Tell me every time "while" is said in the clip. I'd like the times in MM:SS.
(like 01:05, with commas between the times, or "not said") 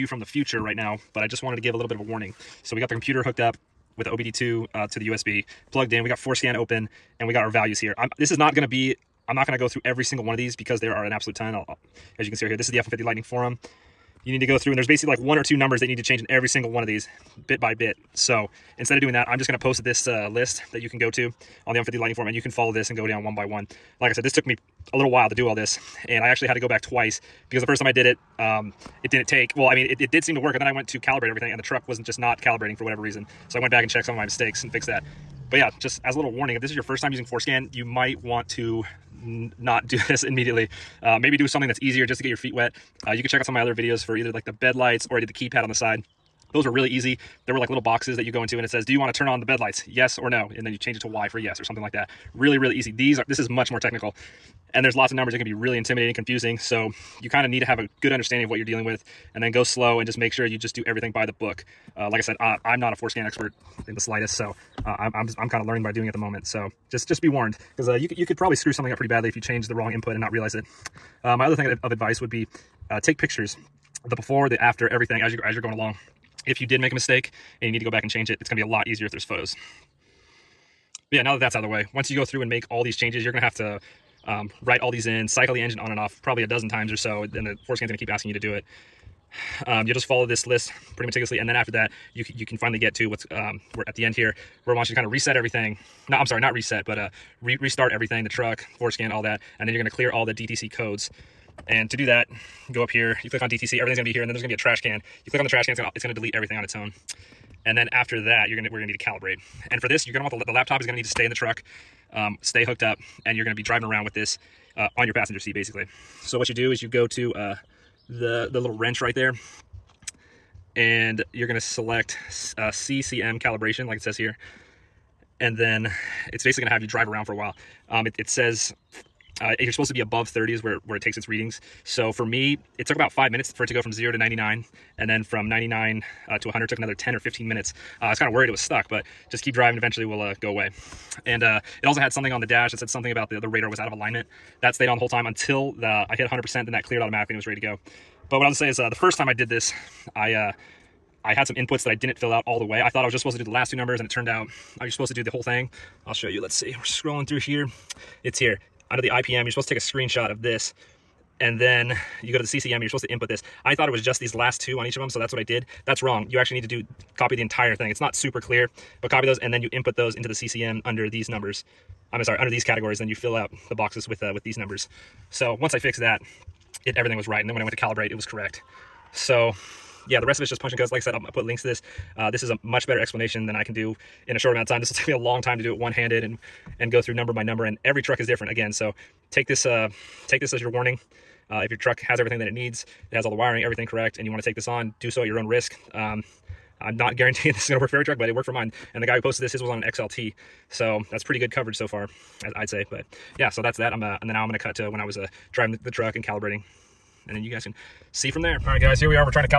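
00:25, 02:07.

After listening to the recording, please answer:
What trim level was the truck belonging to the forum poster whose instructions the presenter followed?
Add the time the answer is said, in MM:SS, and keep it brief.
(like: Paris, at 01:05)
XLT, at 03:19.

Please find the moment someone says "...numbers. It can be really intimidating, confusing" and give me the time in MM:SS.
00:55.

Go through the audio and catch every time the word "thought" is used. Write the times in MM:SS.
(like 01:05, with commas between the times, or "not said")
02:32, 02:43.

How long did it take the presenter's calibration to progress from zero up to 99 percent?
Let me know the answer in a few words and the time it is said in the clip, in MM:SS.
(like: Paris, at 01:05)
5 minutes, at 02:13.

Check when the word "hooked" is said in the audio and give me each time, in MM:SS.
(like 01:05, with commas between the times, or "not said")
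00:03, 01:52.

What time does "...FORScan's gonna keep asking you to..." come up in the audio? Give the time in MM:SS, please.
01:27.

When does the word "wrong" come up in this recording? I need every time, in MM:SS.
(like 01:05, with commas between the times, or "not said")
01:09, 02:46.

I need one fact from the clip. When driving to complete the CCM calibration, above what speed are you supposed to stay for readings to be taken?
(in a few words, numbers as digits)
30.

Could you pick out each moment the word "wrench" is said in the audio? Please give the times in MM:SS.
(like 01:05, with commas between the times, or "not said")
01:58.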